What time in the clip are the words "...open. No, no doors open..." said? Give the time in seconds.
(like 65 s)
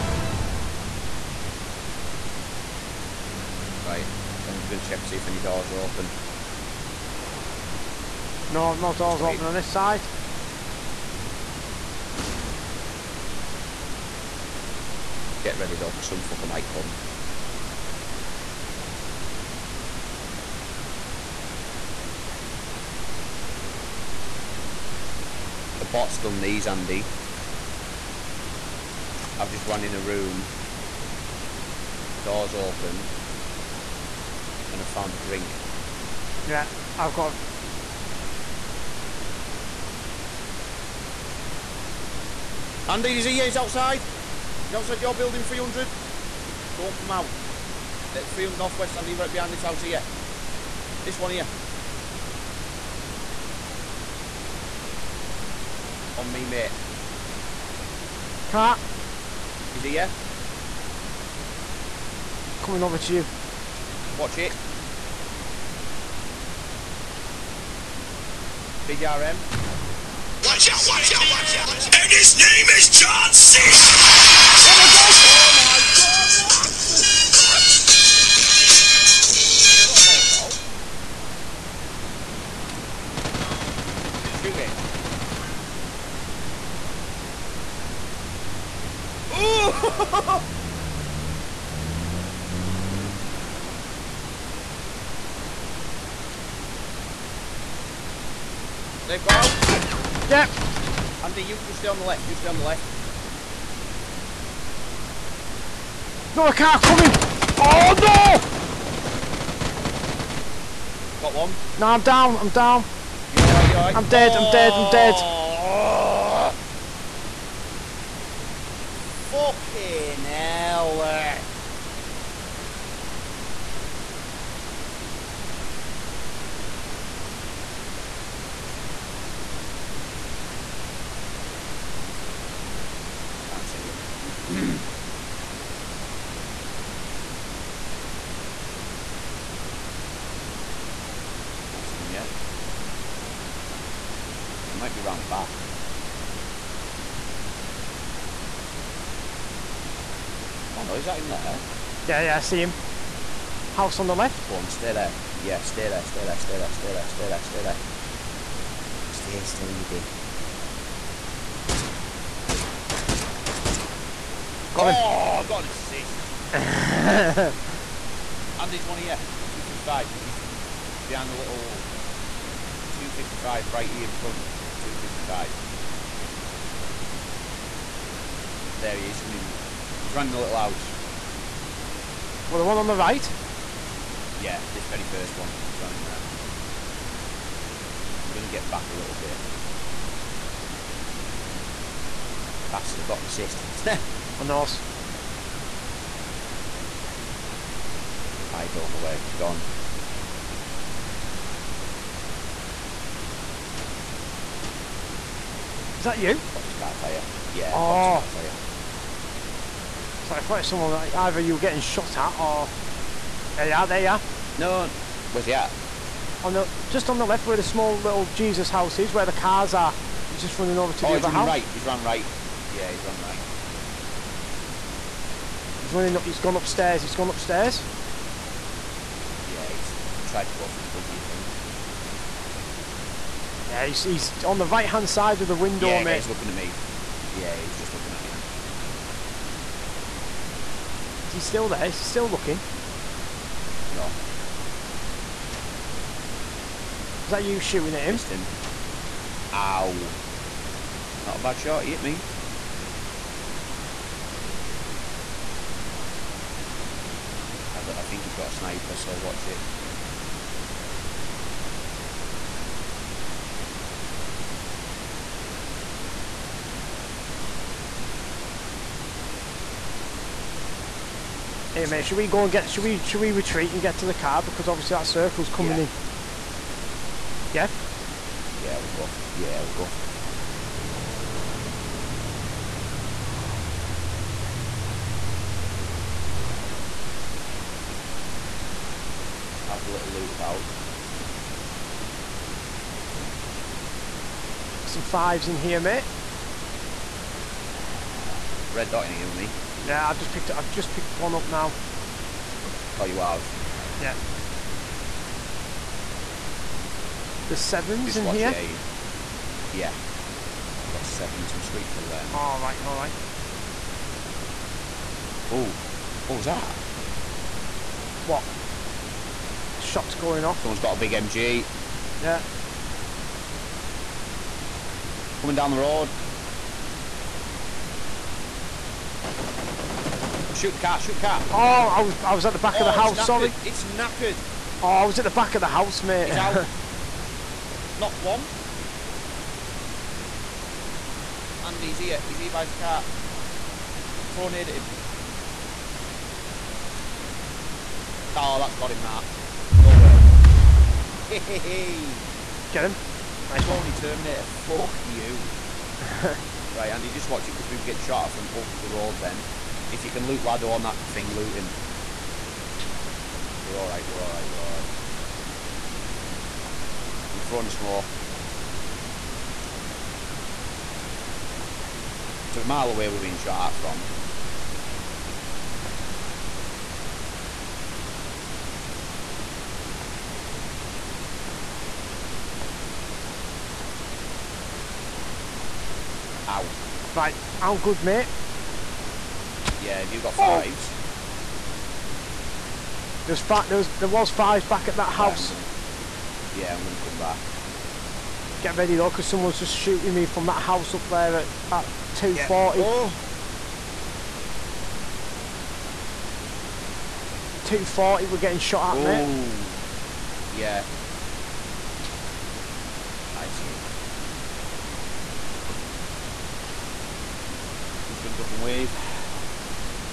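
5 s.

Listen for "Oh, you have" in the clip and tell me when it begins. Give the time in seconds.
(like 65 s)
302 s.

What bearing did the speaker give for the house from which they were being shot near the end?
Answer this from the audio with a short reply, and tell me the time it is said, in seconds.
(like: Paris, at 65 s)
240, at 402 s.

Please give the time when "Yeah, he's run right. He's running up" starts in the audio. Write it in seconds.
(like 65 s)
222 s.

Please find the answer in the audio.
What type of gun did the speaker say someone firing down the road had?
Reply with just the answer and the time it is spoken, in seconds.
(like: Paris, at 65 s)
A big MG, at 320 s.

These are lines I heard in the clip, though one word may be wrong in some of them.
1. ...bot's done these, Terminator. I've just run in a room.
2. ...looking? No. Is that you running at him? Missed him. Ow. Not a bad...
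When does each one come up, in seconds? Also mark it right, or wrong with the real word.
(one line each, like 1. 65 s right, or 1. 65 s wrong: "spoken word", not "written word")
1. 25 s wrong: "Andy", not "Terminator"
2. 242 s wrong: "shooting", not "running".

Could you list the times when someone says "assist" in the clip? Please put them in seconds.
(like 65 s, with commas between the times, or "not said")
165 s, 193 s.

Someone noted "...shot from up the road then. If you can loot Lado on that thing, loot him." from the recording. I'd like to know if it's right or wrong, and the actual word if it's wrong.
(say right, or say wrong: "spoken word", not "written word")
right.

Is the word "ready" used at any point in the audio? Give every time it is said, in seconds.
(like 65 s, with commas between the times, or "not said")
15 s, 398 s.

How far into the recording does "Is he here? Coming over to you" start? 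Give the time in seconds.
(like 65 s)
59 s.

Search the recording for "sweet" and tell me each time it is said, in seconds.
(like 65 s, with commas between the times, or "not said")
311 s.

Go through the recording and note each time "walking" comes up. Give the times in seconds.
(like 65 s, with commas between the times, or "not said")
not said.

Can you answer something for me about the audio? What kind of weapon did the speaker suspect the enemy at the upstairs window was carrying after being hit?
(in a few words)
A sniper.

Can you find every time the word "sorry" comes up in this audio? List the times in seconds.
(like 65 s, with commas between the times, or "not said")
333 s.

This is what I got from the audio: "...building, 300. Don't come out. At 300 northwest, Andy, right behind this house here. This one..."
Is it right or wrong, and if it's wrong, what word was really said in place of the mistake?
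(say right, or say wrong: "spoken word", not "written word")
right.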